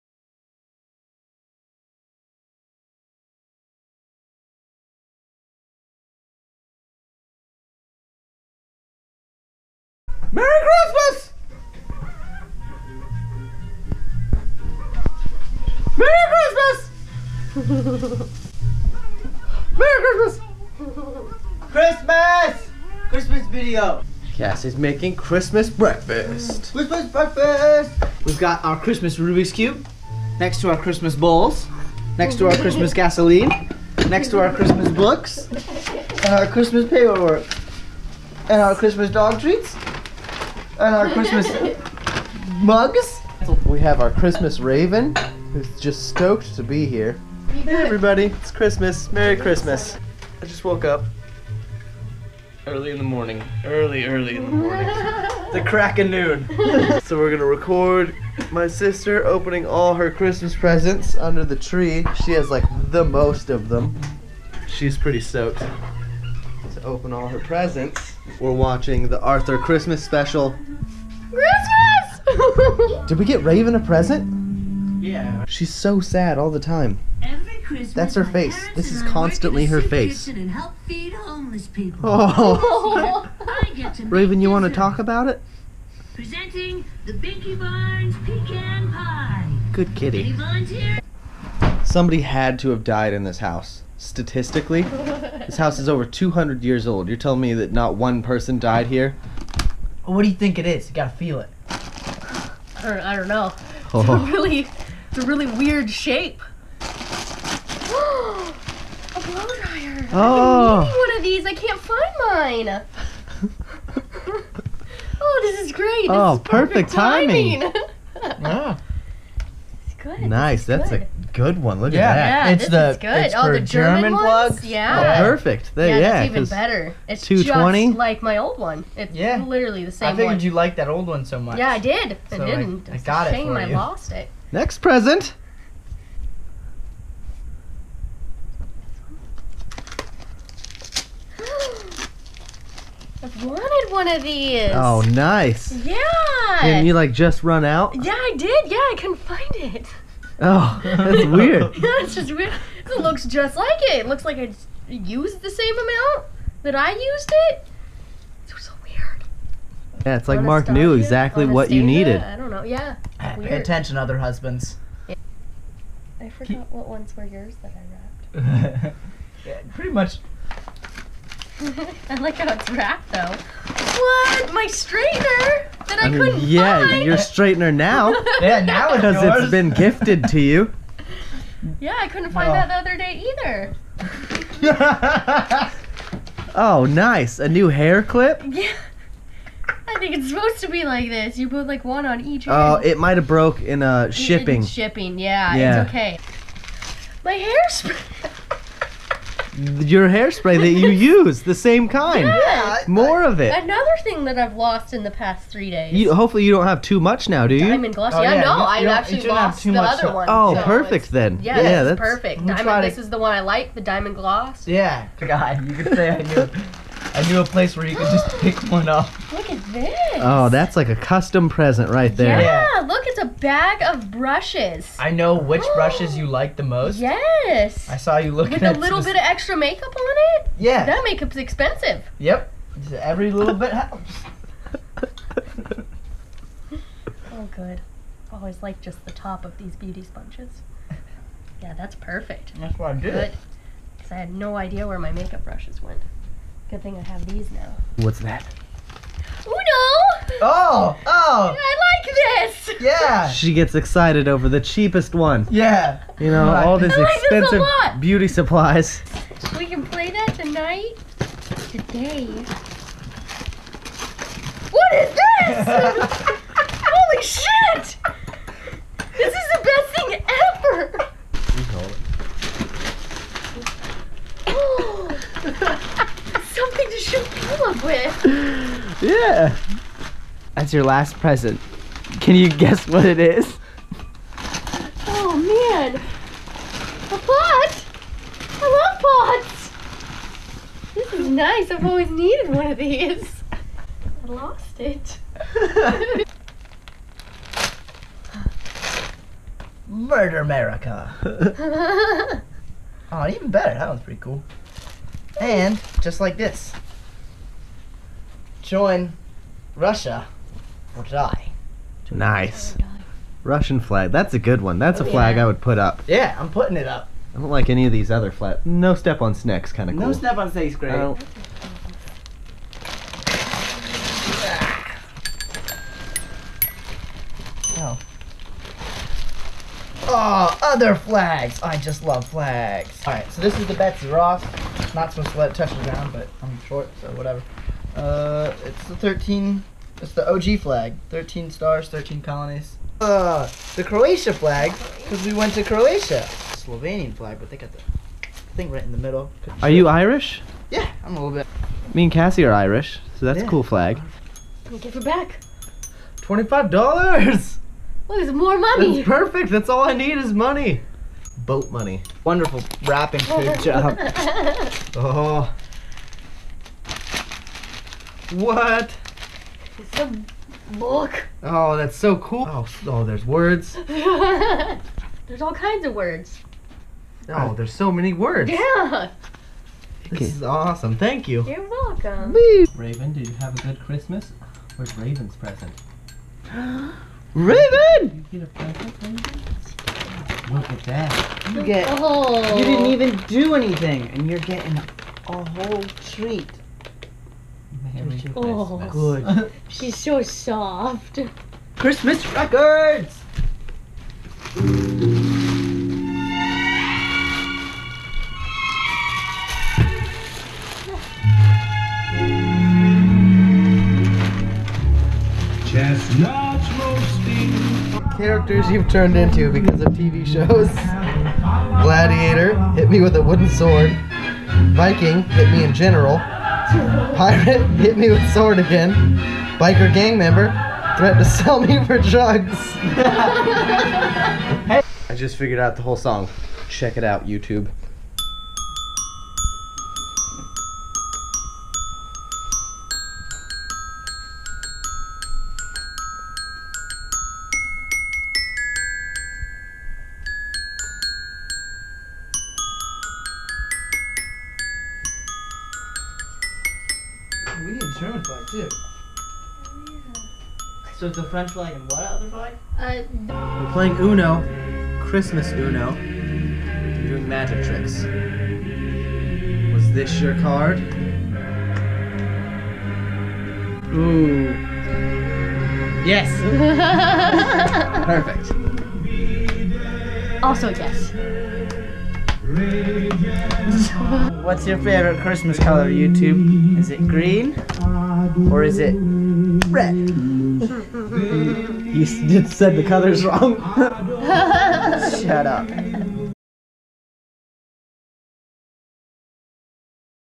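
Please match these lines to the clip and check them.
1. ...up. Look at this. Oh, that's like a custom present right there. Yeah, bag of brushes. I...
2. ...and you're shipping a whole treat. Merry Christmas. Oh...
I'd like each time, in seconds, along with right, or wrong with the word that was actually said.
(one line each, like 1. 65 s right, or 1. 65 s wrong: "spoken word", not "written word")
1. 218 s right
2. 394 s wrong: "getting", not "shipping".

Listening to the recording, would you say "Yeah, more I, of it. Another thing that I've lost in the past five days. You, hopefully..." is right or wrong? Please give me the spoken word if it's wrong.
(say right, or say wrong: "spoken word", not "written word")
wrong: "three", not "five".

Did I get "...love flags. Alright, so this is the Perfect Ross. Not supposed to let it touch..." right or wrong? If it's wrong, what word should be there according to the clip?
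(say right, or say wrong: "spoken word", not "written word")
wrong: "Betsy", not "Perfect".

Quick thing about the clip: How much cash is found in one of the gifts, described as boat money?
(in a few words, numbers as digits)
$25.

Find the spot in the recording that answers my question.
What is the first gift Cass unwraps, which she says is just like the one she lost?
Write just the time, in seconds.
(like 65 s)
106 s.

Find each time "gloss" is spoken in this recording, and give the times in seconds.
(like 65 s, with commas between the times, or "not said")
207 s, 214 s.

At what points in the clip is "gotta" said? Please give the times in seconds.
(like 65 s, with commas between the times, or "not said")
100 s.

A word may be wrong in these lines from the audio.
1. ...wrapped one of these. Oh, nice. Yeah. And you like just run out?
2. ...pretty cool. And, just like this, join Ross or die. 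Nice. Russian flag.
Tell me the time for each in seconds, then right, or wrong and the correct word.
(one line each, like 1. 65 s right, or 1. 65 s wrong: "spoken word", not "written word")
1. 143 s wrong: "wanted", not "wrapped"
2. 304 s wrong: "Russia", not "Ross".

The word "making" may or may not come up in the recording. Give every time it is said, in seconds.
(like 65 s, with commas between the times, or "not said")
24 s.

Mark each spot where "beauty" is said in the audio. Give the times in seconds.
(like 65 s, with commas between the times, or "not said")
239 s, 257 s.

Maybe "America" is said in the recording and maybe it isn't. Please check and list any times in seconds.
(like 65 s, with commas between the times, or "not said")
300 s.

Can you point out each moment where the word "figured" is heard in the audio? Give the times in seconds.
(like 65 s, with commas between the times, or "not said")
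130 s, 435 s.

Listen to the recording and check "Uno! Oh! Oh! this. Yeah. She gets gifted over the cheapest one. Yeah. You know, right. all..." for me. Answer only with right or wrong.
wrong.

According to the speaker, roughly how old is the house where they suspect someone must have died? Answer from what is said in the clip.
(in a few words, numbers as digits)
over 200 years.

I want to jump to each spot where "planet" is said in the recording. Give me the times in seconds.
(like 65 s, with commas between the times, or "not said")
not said.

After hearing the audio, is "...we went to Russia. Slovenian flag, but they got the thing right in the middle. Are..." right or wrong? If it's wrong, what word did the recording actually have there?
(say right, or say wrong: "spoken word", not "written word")
wrong: "Croatia", not "Russia".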